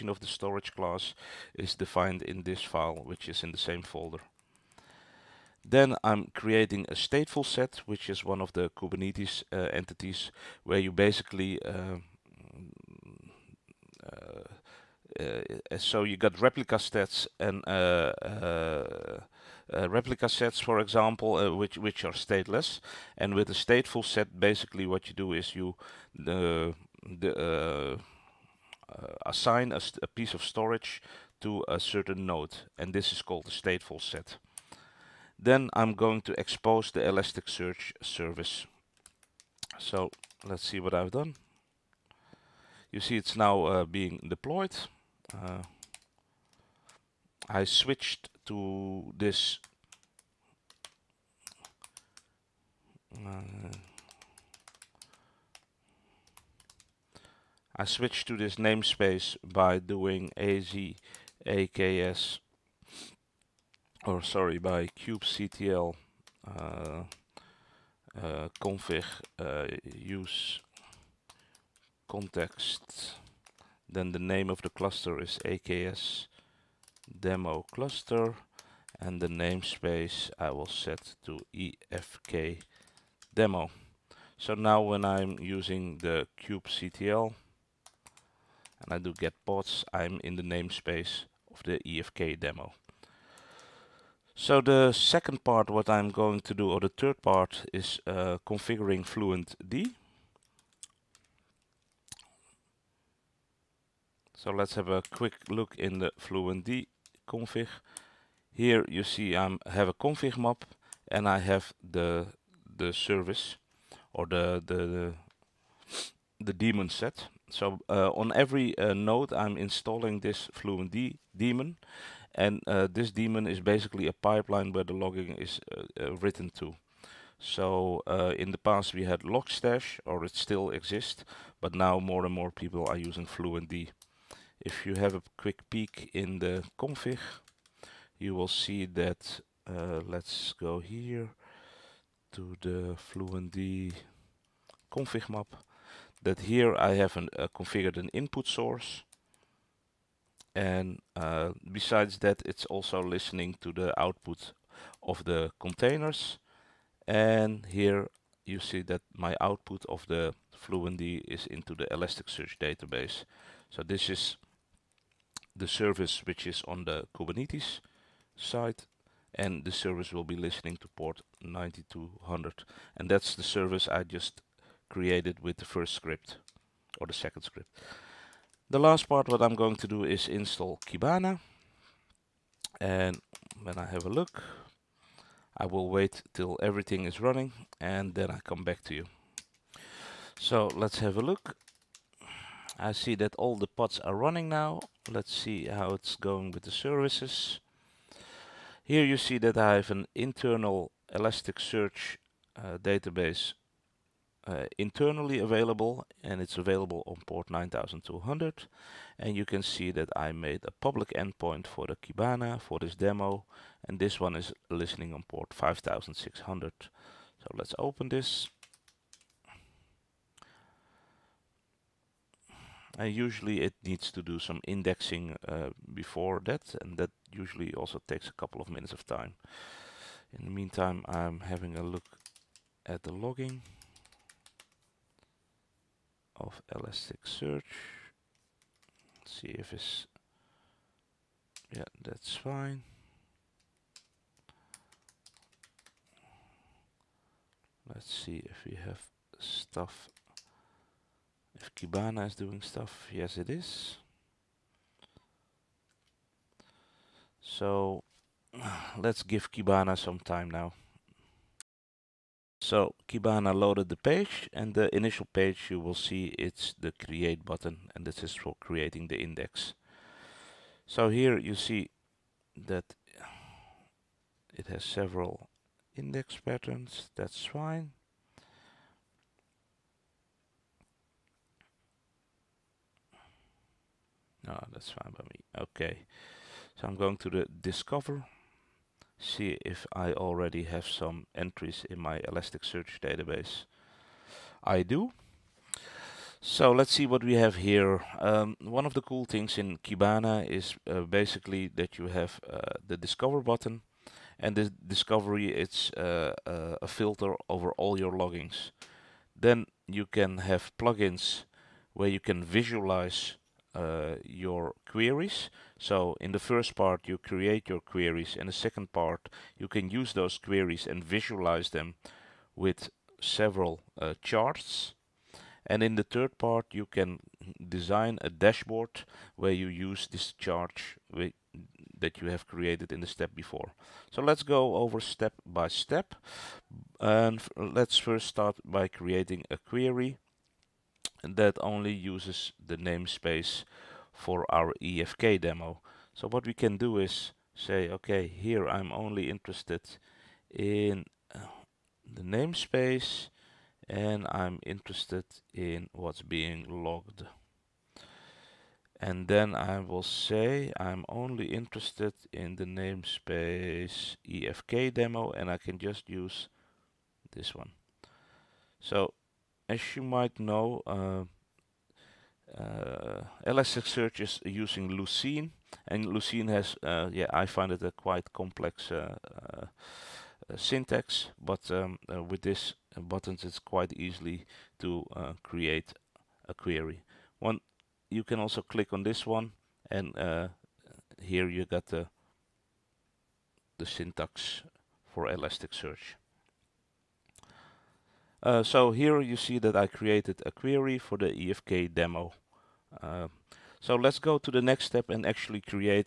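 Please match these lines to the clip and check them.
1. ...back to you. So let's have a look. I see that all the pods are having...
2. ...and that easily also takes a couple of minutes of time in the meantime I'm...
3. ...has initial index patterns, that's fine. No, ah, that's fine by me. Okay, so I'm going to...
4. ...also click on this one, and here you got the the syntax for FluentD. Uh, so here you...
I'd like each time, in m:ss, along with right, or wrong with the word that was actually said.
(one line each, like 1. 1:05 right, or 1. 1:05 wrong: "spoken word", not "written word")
1. 3:08 wrong: "running", not "having"
2. 3:46 wrong: "usually", not "easily"
3. 4:34 wrong: "several", not "initial"
4. 6:28 wrong: "Elasticsearch", not "FluentD".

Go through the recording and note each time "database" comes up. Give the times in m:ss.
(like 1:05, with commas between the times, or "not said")
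2:42, 3:22, 4:53.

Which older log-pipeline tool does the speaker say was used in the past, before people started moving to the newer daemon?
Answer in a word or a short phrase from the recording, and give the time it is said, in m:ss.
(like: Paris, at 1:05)
Logstash, at 2:09.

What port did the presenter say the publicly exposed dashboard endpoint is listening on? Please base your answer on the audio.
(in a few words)
5600.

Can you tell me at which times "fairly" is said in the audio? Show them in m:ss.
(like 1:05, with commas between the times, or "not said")
not said.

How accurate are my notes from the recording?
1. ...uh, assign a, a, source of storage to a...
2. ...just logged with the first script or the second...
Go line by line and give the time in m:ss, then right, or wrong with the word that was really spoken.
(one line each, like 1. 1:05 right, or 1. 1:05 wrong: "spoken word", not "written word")
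1. 0:26 wrong: "piece", not "source"
2. 2:54 wrong: "created", not "logged".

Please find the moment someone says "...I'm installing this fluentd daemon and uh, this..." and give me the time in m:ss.
1:59.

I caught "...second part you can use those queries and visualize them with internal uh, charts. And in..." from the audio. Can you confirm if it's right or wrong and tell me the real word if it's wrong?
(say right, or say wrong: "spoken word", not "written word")
wrong: "several", not "internal".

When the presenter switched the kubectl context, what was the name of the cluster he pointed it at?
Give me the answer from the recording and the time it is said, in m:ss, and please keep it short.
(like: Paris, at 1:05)
AKS demo cluster, at 1:15.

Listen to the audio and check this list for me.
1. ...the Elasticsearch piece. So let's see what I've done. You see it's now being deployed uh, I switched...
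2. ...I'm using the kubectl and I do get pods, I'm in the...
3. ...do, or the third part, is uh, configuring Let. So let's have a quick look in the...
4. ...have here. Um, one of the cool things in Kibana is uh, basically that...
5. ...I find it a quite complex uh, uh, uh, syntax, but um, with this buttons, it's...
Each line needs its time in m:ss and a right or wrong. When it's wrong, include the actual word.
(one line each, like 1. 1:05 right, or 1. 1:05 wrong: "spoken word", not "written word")
1. 0:36 wrong: "service", not "piece"
2. 1:25 right
3. 1:36 wrong: "FluentD", not "Let"
4. 4:57 right
5. 6:17 right.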